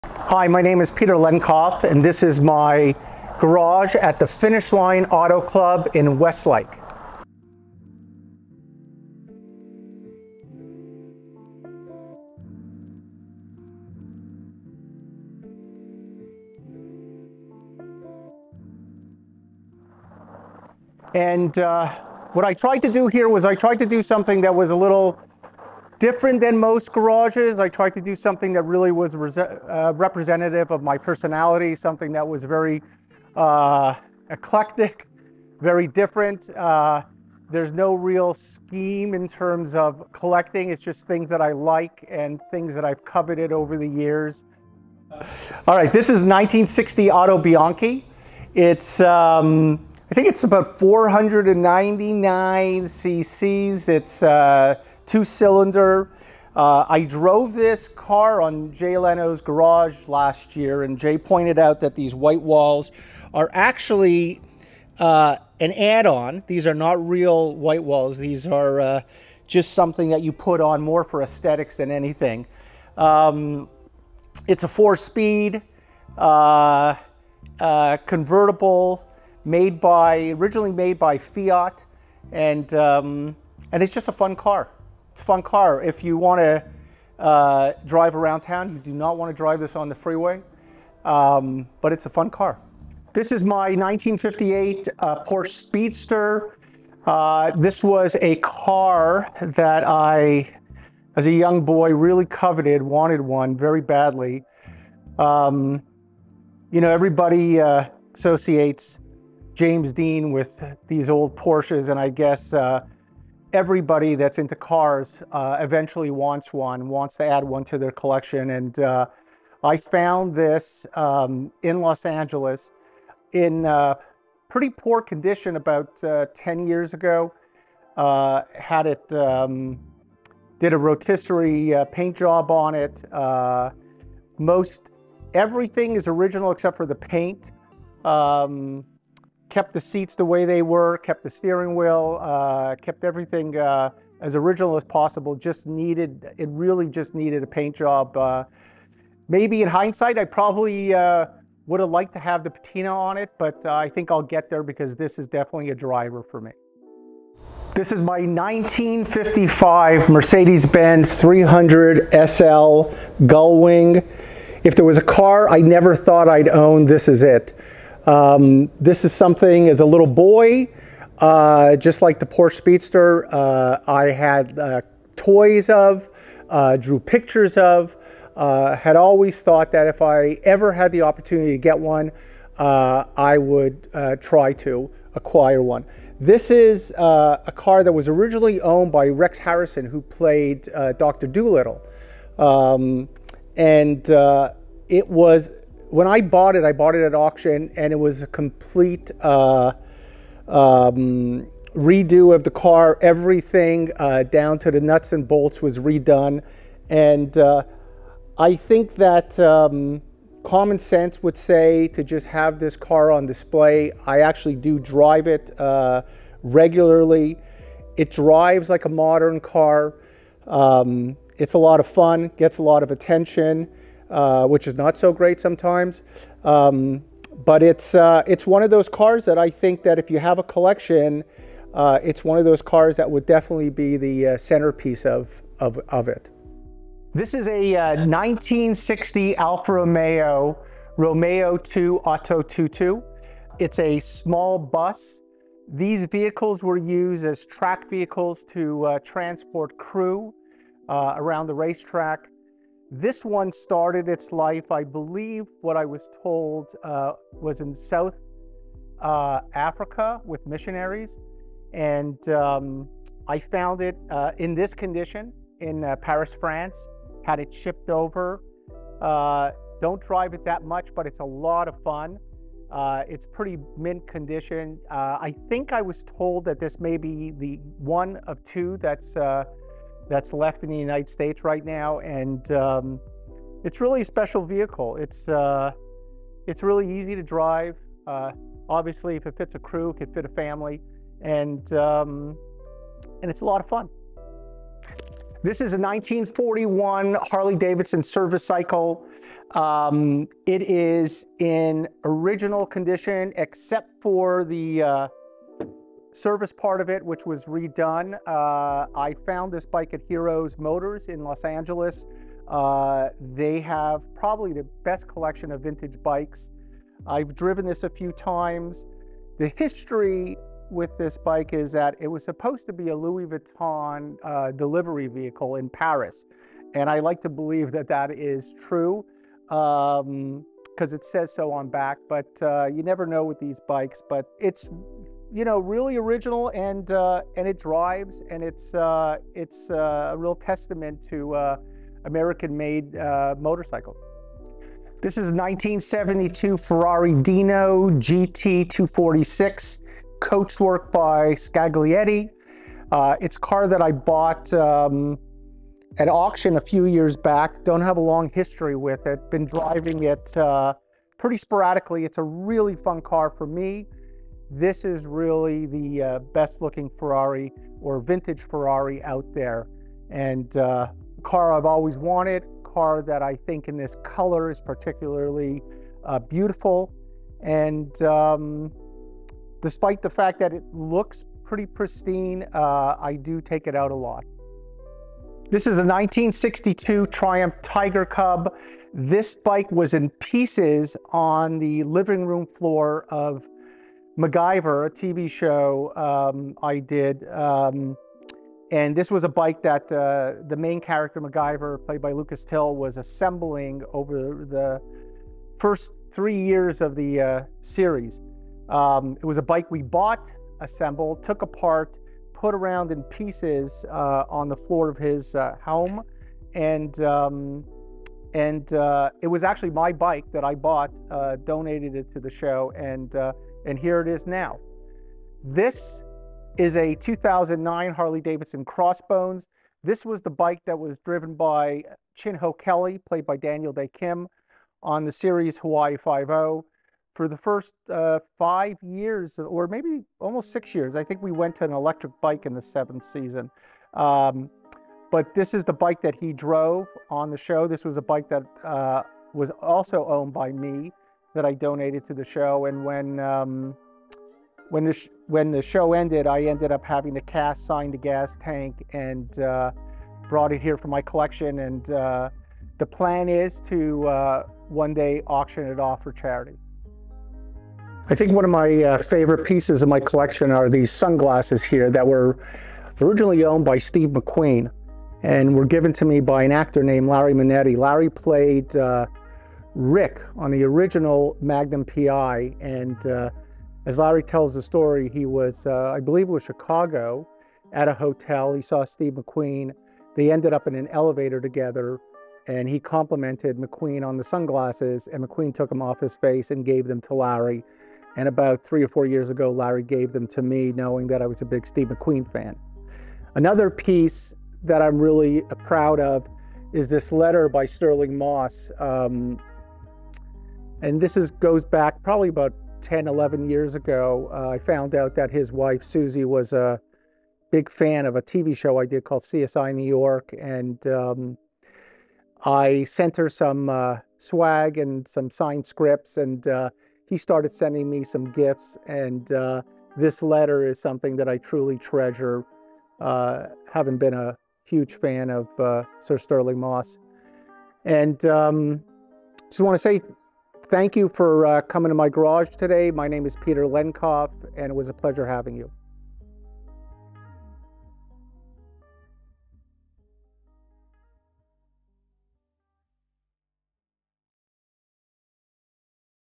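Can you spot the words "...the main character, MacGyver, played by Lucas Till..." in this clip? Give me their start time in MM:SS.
06:40.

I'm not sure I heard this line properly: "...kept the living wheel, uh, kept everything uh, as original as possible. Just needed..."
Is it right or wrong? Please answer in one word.
wrong.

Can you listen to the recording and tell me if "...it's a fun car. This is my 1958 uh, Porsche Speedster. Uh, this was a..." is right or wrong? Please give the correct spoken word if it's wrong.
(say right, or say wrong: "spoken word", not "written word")
right.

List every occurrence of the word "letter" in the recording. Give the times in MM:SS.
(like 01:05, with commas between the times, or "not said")
08:27, 08:50.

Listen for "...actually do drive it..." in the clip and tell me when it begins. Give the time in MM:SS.
03:34.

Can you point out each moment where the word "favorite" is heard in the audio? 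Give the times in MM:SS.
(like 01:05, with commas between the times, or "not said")
07:48.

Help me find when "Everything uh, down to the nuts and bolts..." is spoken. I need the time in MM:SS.
03:23.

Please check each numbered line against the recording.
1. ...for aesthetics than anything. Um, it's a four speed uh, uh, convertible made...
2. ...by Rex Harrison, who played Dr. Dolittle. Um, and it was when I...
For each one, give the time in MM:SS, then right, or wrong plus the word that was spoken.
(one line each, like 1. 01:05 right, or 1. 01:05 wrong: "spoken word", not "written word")
1. 01:11 right
2. 03:08 right.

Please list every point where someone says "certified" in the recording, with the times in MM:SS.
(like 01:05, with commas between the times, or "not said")
not said.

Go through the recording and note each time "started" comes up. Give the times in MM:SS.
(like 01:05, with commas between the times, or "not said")
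04:13, 08:47.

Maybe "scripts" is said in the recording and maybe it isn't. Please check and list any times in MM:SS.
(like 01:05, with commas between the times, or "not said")
08:45.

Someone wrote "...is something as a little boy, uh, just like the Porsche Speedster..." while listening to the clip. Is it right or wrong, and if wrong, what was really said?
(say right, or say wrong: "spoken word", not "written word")
right.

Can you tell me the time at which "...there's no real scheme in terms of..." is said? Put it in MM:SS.
00:37.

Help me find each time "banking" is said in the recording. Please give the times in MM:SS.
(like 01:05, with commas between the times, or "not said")
not said.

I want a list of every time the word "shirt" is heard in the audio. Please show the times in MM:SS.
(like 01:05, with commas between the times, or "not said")
not said.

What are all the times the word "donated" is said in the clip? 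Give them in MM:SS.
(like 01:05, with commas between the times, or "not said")
07:01, 07:31.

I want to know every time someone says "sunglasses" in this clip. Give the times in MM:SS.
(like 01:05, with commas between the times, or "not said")
07:50, 08:14.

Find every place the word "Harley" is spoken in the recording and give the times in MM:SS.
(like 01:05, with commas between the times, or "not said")
04:57, 07:07.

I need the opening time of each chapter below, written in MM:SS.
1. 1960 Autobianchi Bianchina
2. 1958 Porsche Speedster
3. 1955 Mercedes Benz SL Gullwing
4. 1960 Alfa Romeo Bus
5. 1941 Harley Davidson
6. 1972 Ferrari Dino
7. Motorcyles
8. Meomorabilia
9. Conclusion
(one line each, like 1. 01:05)
1. 00:45
2. 01:33
3. 02:38
4. 03:58
5. 04:56
6. 05:45
7. 06:25
8. 07:46
9. 09:00.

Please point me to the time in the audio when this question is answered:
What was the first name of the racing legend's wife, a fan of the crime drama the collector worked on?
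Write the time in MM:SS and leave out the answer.
08:35.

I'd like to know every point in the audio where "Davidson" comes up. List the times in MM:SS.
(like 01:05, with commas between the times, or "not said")
04:57, 07:07.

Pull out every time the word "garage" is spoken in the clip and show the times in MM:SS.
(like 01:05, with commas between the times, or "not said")
00:03, 00:26, 00:59, 09:02.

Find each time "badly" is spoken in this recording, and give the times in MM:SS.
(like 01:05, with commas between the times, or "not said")
01:43.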